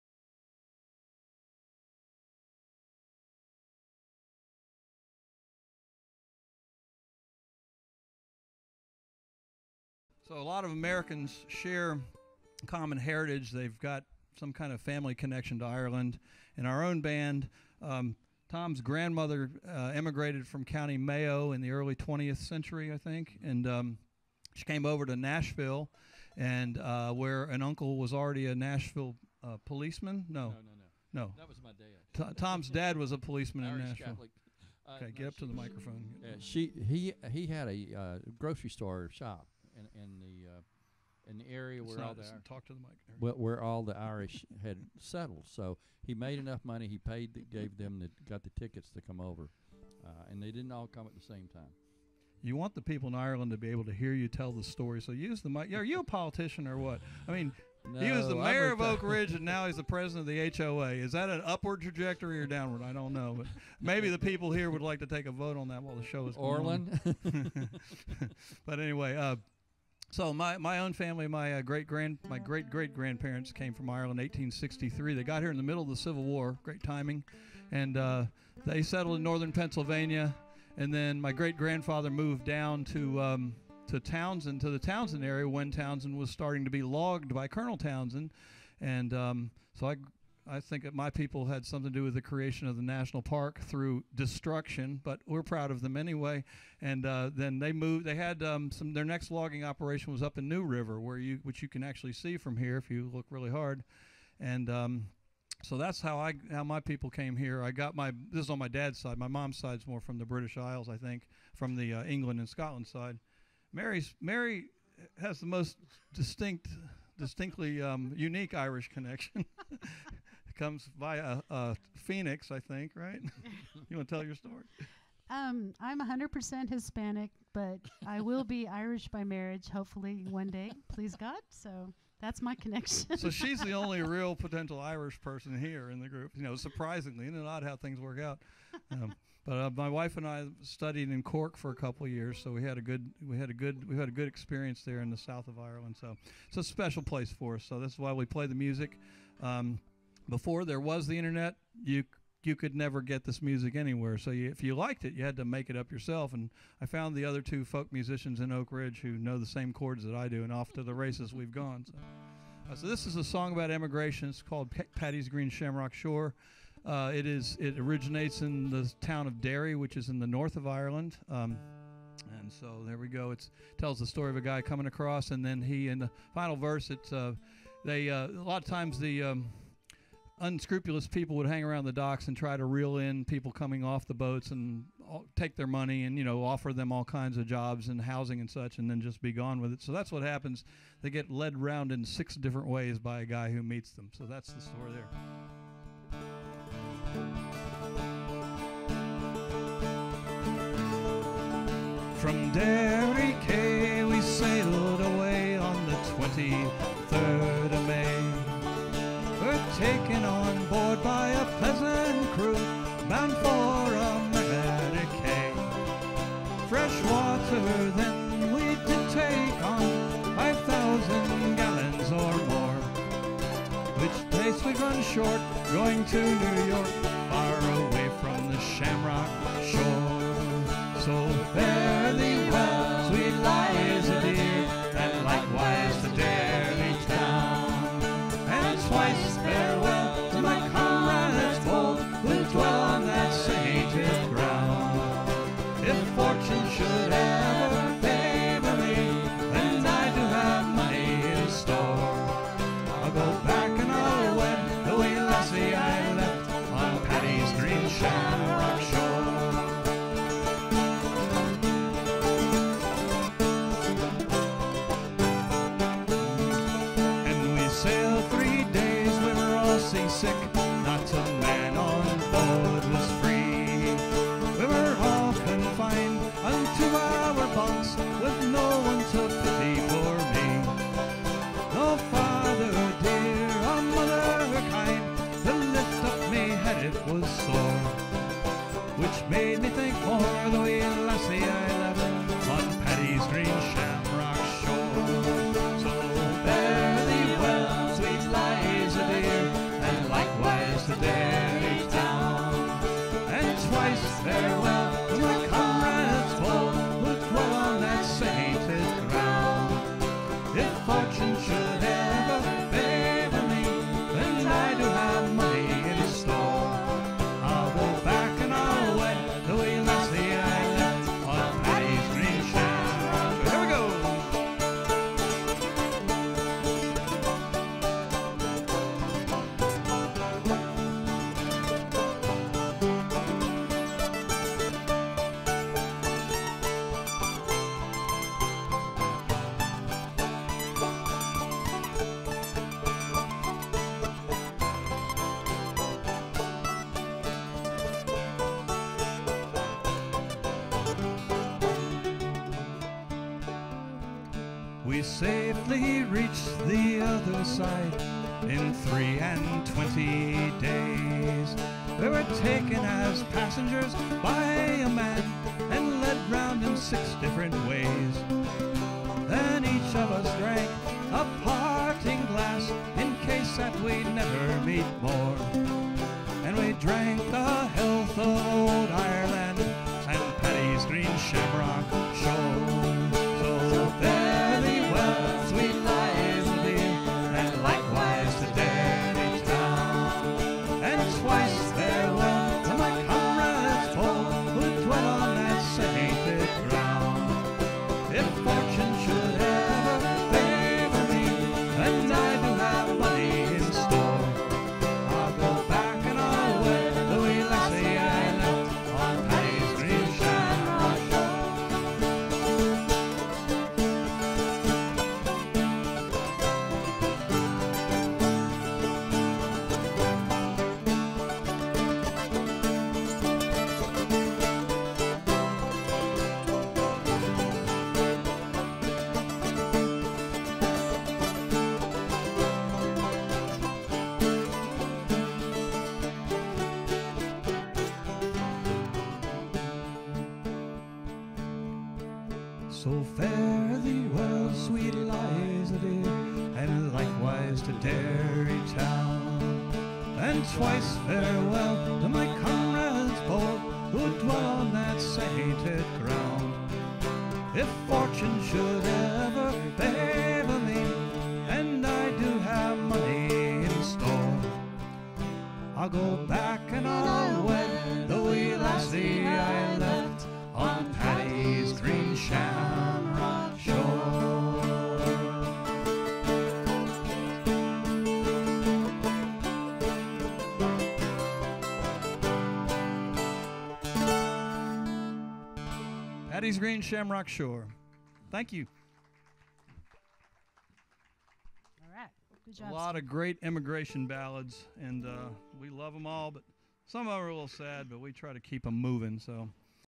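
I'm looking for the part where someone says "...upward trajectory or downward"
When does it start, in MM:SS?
01:01.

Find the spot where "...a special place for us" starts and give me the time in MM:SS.
02:26.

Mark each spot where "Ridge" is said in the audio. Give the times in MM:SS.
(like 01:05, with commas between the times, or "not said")
00:59, 02:38.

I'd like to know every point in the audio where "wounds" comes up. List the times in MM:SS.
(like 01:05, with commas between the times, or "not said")
not said.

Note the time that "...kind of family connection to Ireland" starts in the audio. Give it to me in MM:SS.
00:14.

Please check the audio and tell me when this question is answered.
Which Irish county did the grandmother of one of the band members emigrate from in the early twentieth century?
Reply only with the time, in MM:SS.
00:20.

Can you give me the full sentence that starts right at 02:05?
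Um, I'm 100% Hispanic, but I will be Irish by marriage, hopefully one day, please God.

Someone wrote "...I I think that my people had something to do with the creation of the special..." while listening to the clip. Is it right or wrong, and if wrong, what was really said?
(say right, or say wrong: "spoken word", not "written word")
wrong: "national", not "special".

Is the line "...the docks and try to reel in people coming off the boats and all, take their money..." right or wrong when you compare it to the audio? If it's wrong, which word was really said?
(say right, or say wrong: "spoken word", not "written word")
right.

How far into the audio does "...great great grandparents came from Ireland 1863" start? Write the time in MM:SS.
01:12.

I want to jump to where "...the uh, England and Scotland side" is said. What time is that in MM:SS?
01:51.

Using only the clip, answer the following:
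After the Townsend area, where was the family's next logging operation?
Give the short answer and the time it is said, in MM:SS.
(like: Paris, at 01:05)
New River, at 01:40.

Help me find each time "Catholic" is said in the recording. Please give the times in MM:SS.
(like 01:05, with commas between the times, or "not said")
00:34.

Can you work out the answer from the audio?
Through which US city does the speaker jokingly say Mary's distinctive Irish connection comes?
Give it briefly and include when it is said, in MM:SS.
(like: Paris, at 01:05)
Phoenix, at 02:01.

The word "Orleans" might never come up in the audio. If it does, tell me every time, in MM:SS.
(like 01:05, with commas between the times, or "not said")
not said.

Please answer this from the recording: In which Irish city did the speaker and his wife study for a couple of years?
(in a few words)
Cork.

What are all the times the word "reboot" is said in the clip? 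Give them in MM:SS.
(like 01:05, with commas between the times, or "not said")
not said.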